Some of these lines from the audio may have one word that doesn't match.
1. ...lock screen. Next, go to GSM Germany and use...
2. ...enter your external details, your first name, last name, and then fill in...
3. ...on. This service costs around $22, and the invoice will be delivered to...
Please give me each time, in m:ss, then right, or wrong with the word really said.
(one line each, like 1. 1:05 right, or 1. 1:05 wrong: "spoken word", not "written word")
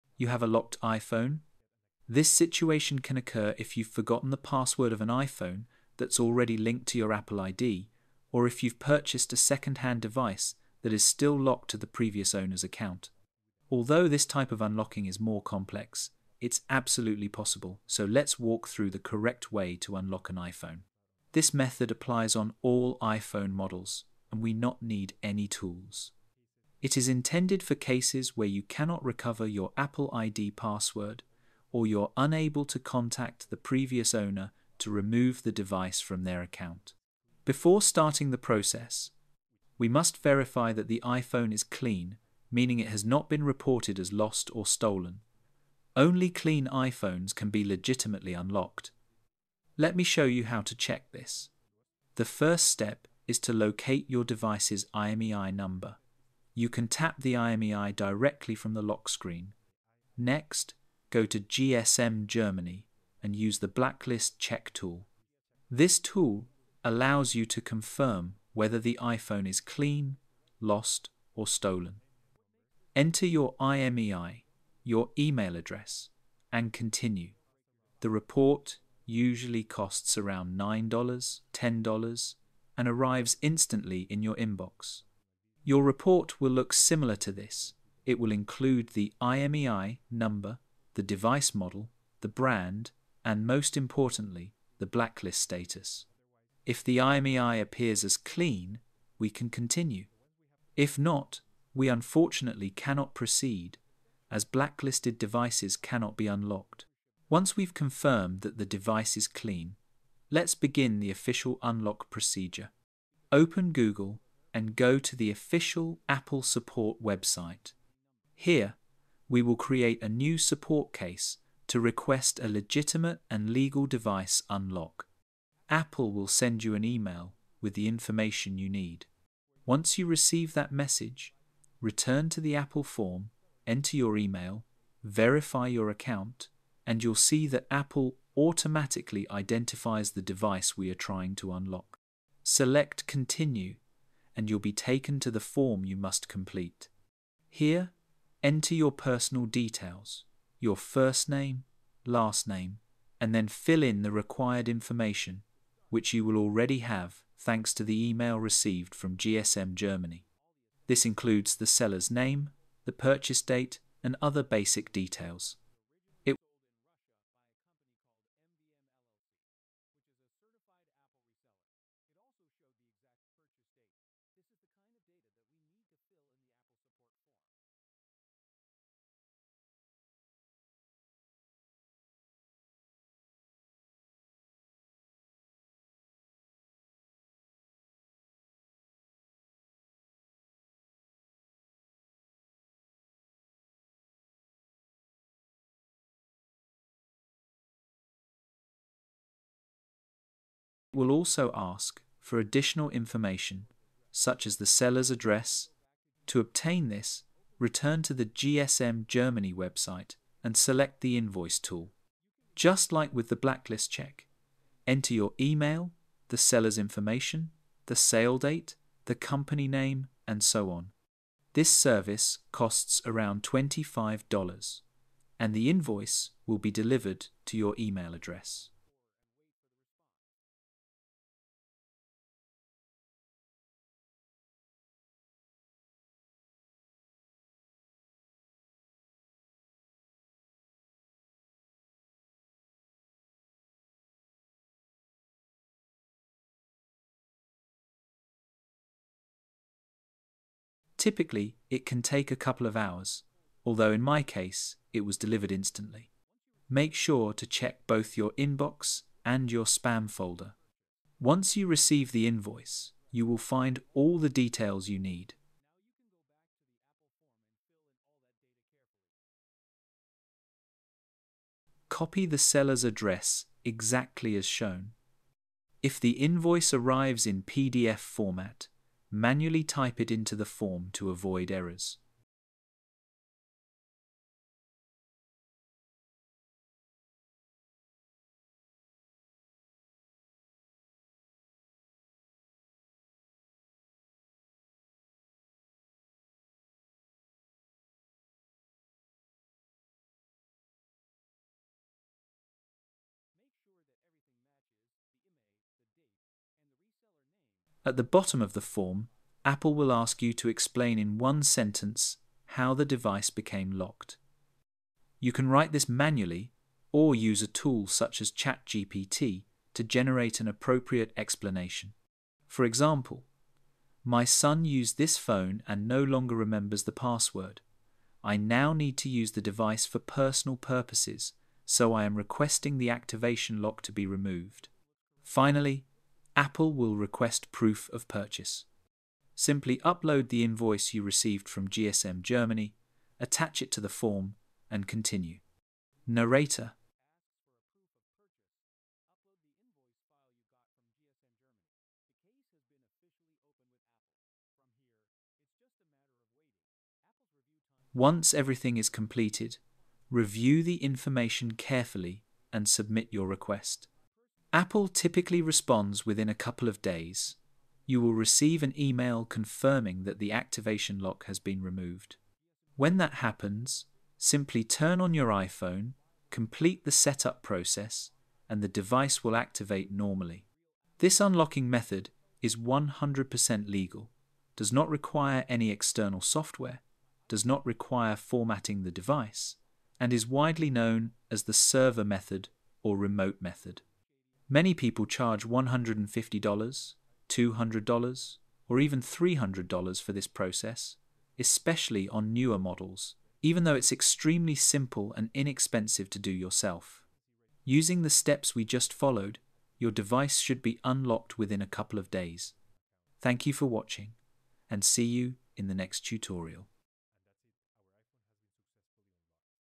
1. 0:58 right
2. 2:28 wrong: "personal", not "external"
3. 3:40 wrong: "25", not "22".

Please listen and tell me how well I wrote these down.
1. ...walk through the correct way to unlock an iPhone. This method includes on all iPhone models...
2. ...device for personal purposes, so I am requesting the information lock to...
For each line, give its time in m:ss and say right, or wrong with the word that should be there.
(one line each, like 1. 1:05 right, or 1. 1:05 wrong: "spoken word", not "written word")
1. 0:18 wrong: "applies", not "includes"
2. 5:29 wrong: "activation", not "information".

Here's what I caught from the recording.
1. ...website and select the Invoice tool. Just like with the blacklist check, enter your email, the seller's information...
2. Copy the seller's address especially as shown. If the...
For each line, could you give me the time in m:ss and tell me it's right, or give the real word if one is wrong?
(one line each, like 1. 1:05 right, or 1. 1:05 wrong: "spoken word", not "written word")
1. 3:29 right
2. 4:31 wrong: "exactly", not "especially".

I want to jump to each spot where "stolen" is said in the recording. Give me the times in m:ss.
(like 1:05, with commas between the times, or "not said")
0:44, 1:11.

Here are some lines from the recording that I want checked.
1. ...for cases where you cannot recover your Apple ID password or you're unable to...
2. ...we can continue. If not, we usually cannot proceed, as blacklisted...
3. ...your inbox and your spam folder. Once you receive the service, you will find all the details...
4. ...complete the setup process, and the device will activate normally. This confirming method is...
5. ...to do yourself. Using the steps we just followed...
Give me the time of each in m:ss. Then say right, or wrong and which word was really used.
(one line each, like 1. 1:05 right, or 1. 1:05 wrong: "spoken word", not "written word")
1. 0:27 right
2. 1:39 wrong: "unfortunately", not "usually"
3. 4:18 wrong: "invoice", not "service"
4. 6:16 wrong: "unlocking", not "confirming"
5. 6:46 right.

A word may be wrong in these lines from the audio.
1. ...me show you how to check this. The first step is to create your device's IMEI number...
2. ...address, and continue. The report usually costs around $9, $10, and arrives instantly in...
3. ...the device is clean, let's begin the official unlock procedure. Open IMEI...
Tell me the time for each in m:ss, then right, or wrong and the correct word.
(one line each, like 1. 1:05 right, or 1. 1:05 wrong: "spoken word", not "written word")
1. 0:49 wrong: "locate", not "create"
2. 1:15 right
3. 1:48 wrong: "Google", not "IMEI".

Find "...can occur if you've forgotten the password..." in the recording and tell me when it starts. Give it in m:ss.
0:02.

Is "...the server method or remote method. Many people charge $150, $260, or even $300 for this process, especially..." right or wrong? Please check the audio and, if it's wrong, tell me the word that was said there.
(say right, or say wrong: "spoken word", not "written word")
wrong: "200", not "260".